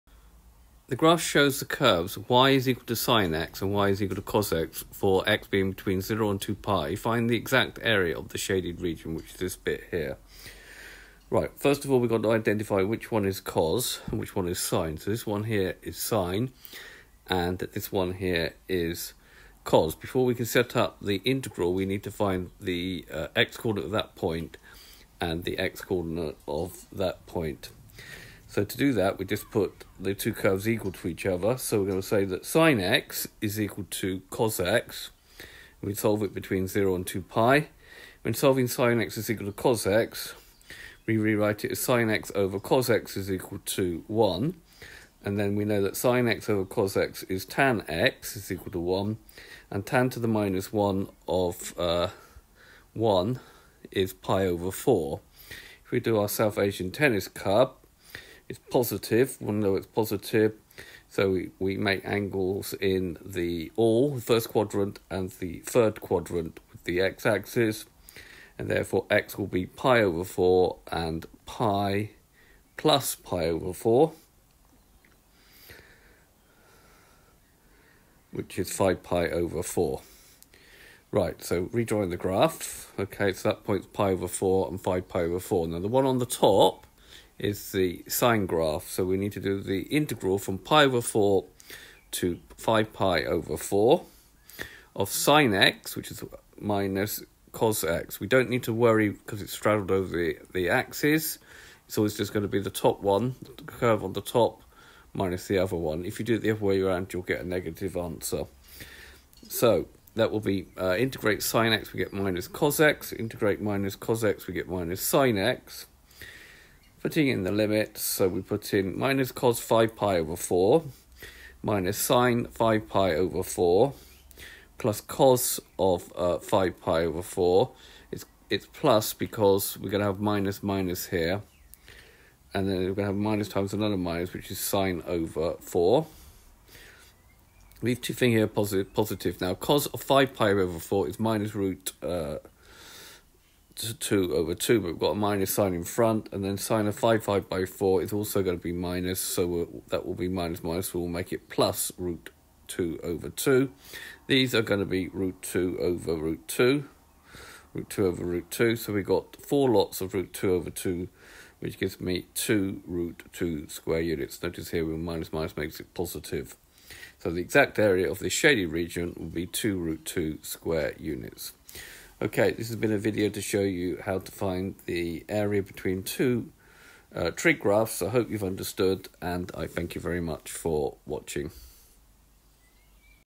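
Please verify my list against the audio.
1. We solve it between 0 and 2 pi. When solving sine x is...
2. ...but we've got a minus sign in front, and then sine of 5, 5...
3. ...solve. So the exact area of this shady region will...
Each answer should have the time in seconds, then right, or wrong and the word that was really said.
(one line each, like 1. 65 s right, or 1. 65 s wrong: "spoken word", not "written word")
1. 35 s right
2. 144 s right
3. 165 s wrong: "positive", not "solve".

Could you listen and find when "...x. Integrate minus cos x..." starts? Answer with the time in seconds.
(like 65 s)
112 s.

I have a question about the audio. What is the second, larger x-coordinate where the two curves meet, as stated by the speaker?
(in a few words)
5 pi over 4.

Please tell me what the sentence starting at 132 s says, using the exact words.
And then we're going to have minus times another minus, which is sine over 4.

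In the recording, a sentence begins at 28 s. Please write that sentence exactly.
So to do that, we just put the two curves equal to each other.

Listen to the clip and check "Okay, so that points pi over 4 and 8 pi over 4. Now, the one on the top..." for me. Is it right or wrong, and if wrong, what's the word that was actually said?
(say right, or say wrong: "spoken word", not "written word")
wrong: "5", not "8".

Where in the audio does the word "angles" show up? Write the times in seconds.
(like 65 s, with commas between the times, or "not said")
62 s.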